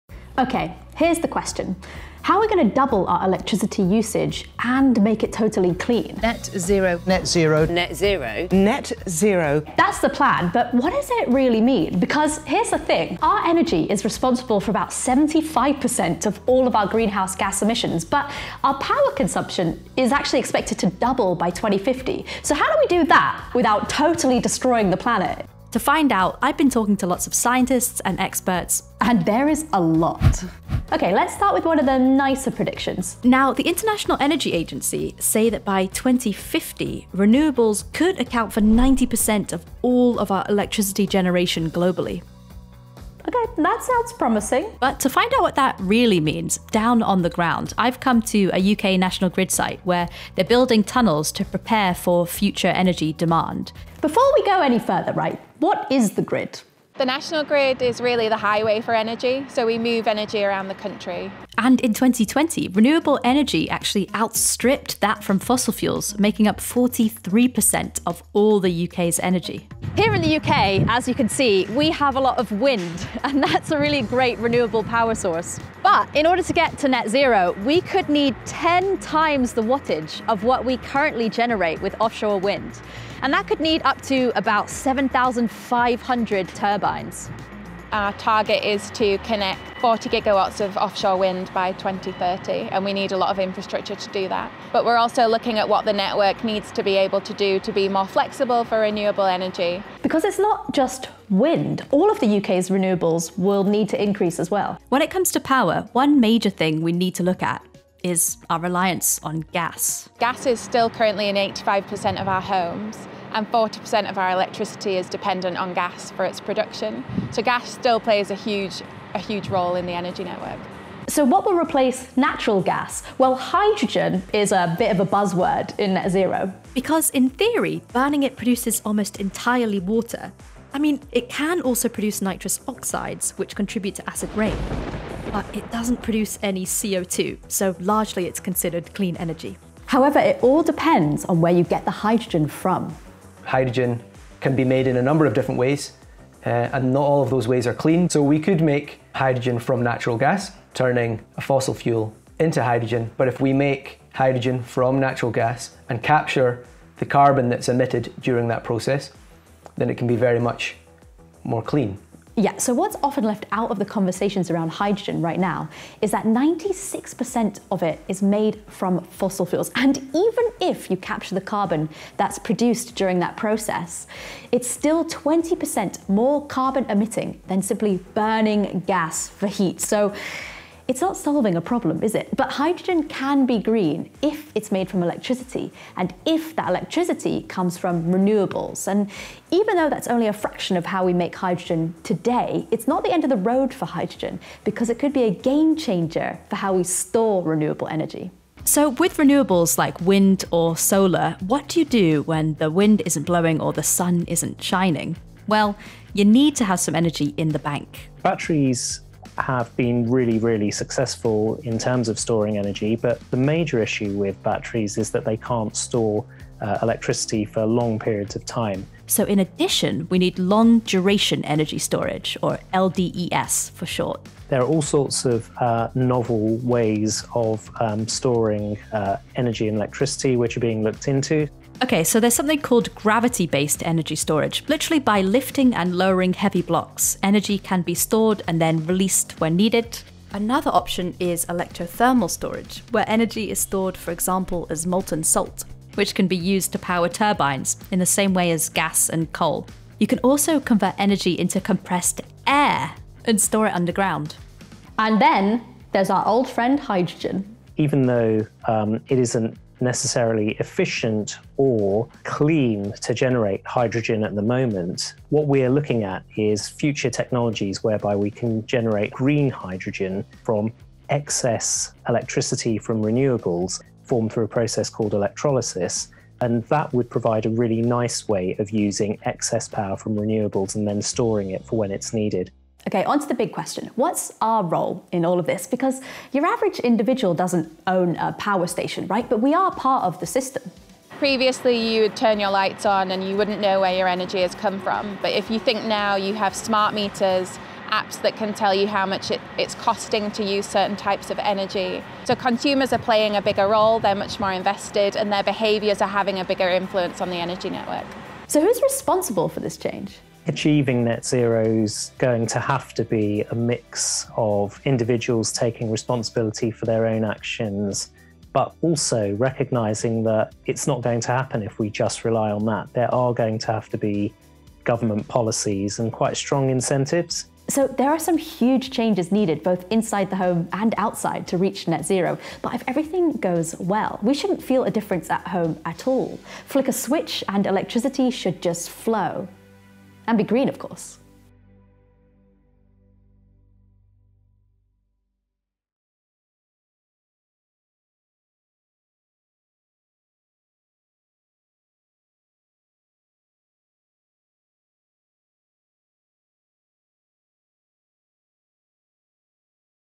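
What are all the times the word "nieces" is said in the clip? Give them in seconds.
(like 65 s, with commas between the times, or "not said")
not said.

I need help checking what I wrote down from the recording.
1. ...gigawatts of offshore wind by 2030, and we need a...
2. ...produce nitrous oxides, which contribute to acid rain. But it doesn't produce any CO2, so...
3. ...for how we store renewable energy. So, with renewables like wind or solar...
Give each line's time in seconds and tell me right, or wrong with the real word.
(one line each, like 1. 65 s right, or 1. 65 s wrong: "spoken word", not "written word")
1. 90 s right
2. 131 s right
3. 196 s right.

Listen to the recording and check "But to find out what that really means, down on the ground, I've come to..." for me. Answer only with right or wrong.
right.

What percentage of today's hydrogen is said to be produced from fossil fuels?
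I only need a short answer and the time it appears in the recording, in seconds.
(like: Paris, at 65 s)
96%, at 166 s.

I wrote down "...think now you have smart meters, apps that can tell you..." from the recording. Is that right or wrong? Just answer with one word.
right.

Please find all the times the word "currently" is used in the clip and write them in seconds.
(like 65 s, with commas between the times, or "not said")
80 s, 110 s.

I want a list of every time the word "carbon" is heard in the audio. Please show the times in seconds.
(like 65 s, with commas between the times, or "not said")
157 s, 171 s, 176 s.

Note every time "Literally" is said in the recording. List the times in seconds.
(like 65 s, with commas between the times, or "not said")
234 s.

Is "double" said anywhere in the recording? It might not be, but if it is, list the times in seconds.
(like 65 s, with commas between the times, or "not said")
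2 s, 20 s.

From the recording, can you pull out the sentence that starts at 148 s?
So we could make hydrogen from natural gas, turning a fossil fuel into hydrogen.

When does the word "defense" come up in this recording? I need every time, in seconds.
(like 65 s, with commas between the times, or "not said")
not said.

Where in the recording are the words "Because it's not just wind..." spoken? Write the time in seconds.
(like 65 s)
100 s.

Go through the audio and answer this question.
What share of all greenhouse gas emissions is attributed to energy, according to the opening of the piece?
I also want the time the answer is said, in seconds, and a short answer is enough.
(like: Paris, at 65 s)
75%, at 14 s.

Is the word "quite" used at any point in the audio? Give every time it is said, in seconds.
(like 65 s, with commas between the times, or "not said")
326 s.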